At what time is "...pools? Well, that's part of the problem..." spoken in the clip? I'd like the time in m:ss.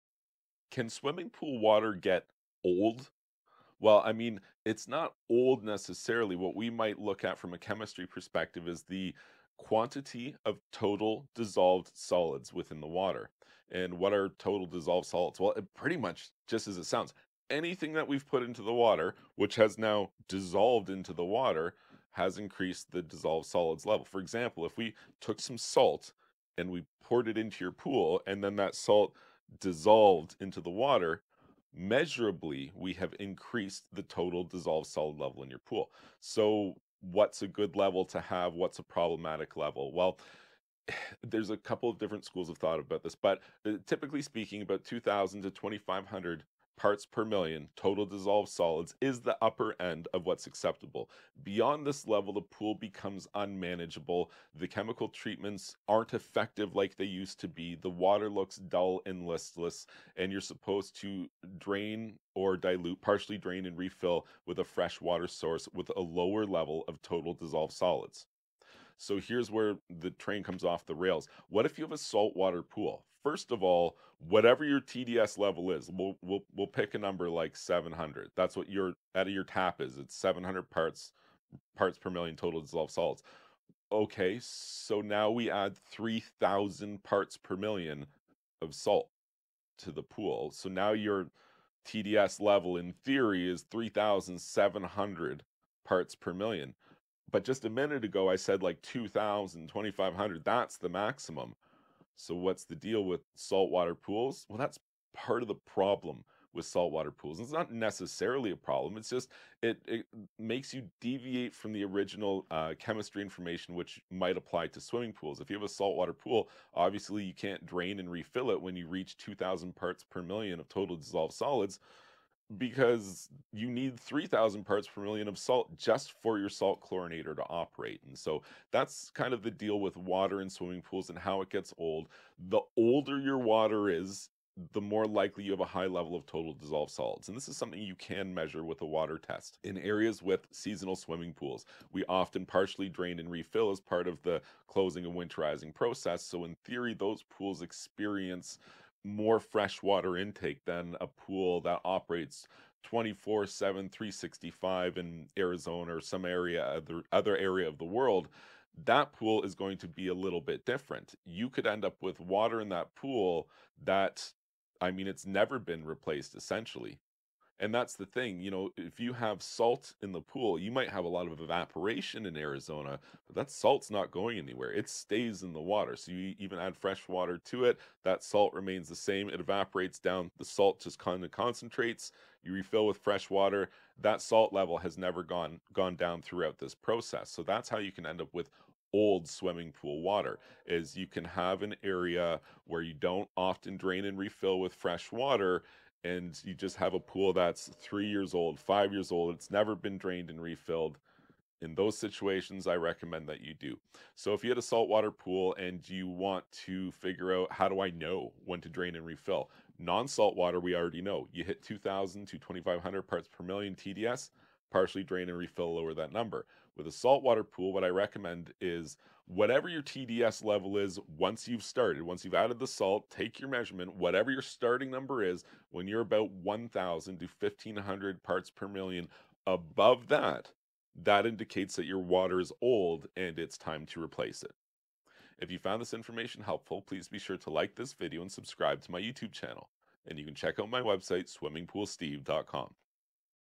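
1:43.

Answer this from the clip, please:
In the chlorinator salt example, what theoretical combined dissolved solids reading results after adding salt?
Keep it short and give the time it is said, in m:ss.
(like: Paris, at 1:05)
3,700 parts per million, at 1:33.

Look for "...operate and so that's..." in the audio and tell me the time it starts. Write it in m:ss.
2:07.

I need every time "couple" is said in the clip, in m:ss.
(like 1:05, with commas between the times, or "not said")
0:41.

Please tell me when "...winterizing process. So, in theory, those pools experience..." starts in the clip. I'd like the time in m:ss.
2:25.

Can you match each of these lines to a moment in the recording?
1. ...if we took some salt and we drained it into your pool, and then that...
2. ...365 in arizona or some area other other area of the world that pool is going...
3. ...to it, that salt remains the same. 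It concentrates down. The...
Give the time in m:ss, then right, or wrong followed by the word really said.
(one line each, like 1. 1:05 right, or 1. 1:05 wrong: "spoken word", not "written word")
1. 0:24 wrong: "poured", not "drained"
2. 2:33 right
3. 2:57 wrong: "evaporates", not "concentrates".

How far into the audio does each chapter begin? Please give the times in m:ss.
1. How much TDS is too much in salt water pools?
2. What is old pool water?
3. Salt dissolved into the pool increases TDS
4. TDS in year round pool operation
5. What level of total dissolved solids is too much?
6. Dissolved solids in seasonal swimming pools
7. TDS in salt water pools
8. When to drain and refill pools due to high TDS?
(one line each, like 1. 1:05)
1. 1:55
2. 3:10
3. 0:25
4. 2:40
5. 0:45
6. 2:20
7. 1:10
8. 3:30.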